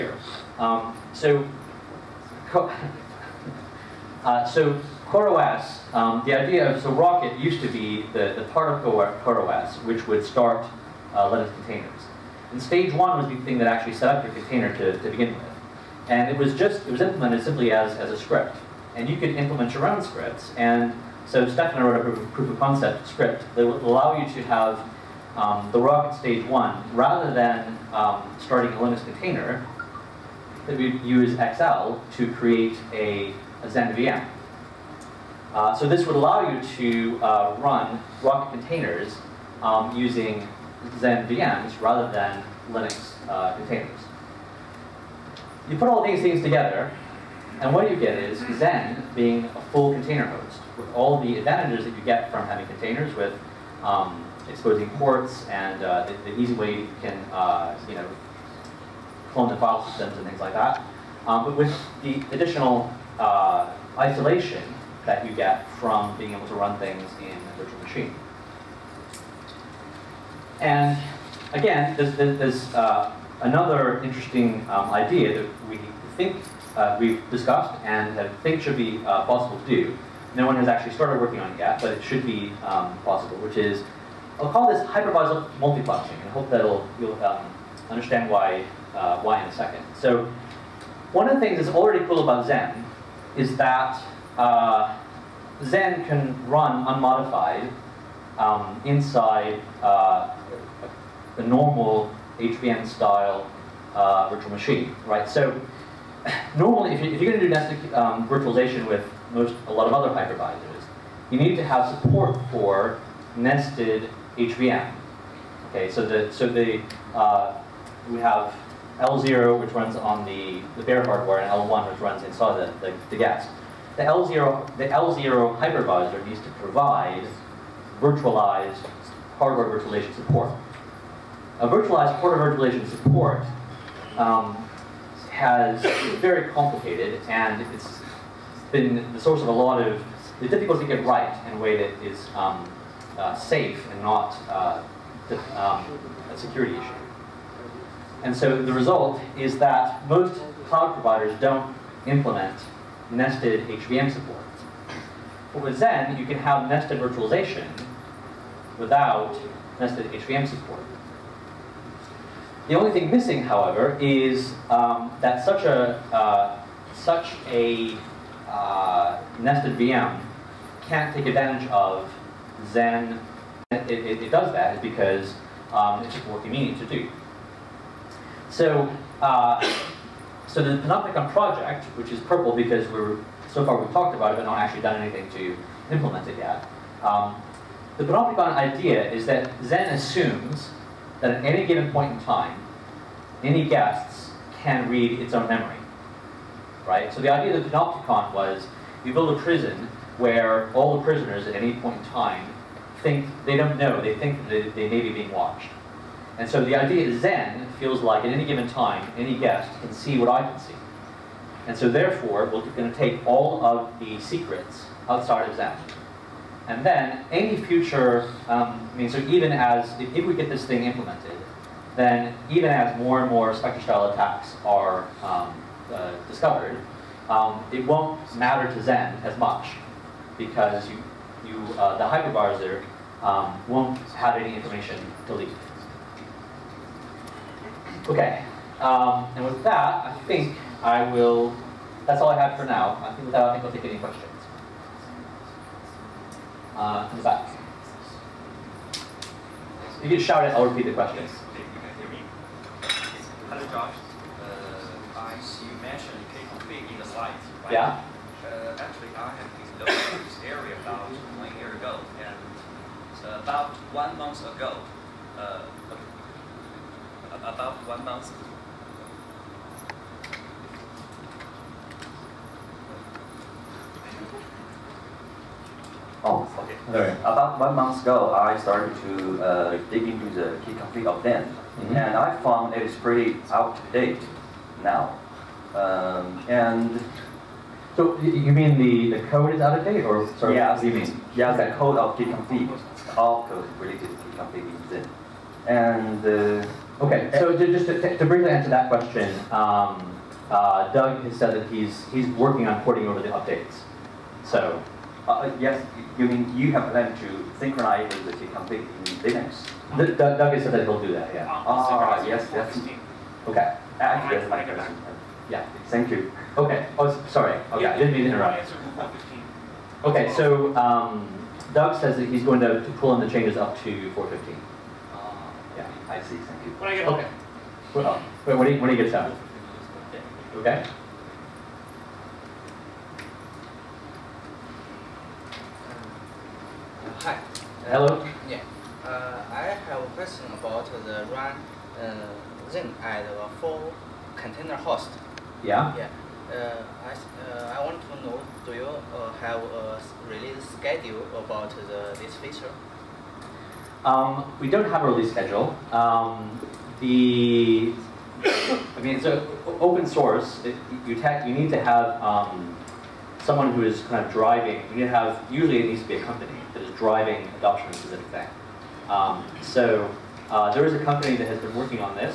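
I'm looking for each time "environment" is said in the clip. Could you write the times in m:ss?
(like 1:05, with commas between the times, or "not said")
not said.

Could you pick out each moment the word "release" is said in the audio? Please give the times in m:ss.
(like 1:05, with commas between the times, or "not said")
5:50, 5:55.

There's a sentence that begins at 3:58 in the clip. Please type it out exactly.
Okay, um, and with that, I think I will, that's all I have for now.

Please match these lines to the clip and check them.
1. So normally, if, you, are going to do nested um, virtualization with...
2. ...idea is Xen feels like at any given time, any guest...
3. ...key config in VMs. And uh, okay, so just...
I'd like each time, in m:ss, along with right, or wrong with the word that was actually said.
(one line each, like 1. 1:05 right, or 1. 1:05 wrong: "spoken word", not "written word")
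1. 1:45 right
2. 3:26 right
3. 4:54 wrong: "Xen", not "VMs".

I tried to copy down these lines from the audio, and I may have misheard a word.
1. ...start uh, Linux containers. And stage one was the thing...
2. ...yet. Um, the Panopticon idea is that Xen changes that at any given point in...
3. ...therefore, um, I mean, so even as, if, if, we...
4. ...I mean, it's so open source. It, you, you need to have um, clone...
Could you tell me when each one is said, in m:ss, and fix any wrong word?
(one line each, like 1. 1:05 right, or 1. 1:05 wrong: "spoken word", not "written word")
1. 0:10 right
2. 3:06 wrong: "assumes", not "changes"
3. 3:37 wrong: "future", not "therefore"
4. 5:58 wrong: "someone", not "clone".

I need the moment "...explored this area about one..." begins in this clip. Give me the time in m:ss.
4:19.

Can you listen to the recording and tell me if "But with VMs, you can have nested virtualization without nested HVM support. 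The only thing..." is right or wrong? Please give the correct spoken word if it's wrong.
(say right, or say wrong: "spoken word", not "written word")
wrong: "Xen", not "VMs".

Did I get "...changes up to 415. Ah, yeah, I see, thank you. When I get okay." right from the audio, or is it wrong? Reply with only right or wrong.
right.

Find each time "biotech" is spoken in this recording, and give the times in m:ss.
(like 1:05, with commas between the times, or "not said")
not said.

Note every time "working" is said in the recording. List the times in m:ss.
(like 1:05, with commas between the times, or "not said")
1:21, 5:02, 6:11.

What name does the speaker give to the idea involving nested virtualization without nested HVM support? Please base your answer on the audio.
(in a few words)
hypervisor multiplexing.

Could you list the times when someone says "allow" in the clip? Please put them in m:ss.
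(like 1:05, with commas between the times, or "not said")
0:23, 0:36.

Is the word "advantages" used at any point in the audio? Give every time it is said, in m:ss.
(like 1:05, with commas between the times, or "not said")
0:51, 2:51.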